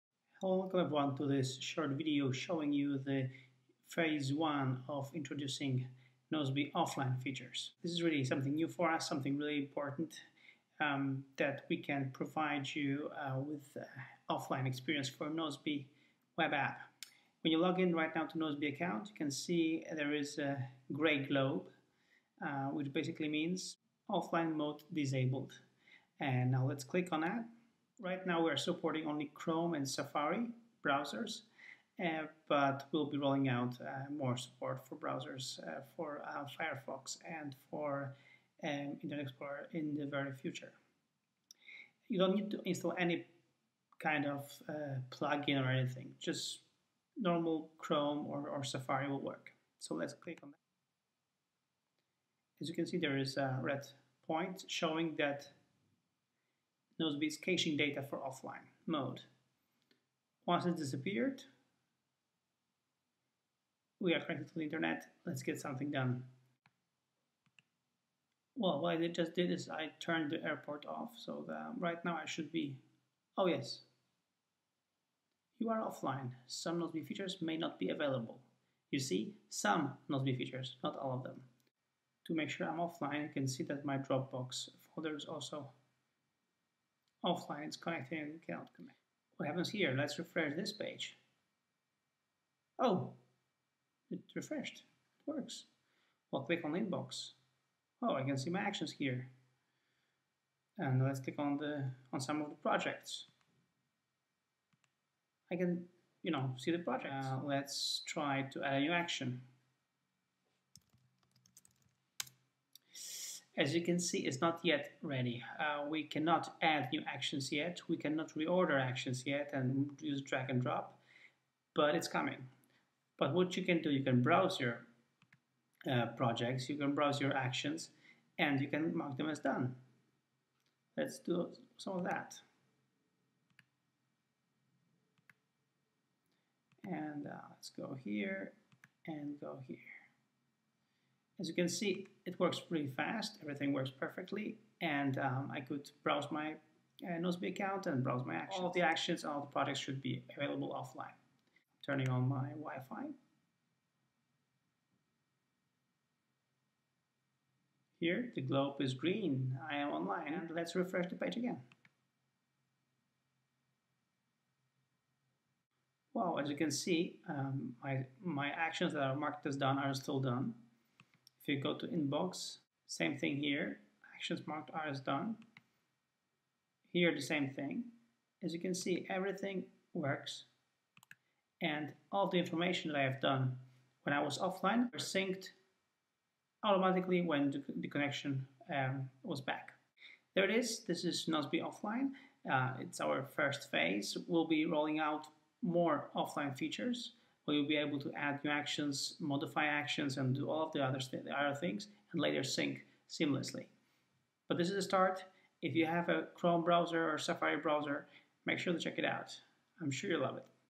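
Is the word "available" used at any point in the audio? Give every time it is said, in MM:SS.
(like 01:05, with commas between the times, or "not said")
01:17, 02:30.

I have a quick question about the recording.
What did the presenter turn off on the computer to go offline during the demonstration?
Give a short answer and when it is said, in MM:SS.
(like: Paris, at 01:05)
The airport, at 01:10.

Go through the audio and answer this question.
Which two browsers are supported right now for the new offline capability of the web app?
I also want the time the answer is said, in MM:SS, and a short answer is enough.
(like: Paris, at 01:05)
Chrome and Safari, at 00:29.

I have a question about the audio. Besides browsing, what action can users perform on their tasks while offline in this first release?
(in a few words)
Mark them as done.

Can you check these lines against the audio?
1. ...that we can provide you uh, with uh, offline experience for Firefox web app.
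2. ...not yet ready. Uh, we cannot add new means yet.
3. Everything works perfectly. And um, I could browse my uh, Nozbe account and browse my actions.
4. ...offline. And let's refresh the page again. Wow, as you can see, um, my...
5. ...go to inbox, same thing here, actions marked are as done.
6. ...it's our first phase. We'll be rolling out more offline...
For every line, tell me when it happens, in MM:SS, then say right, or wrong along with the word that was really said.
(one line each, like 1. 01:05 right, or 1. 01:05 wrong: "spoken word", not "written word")
1. 00:11 wrong: "Nozbe", not "Firefox"
2. 01:54 wrong: "actions", not "means"
3. 02:23 right
4. 02:39 wrong: "online", not "offline"
5. 02:51 right
6. 03:12 right.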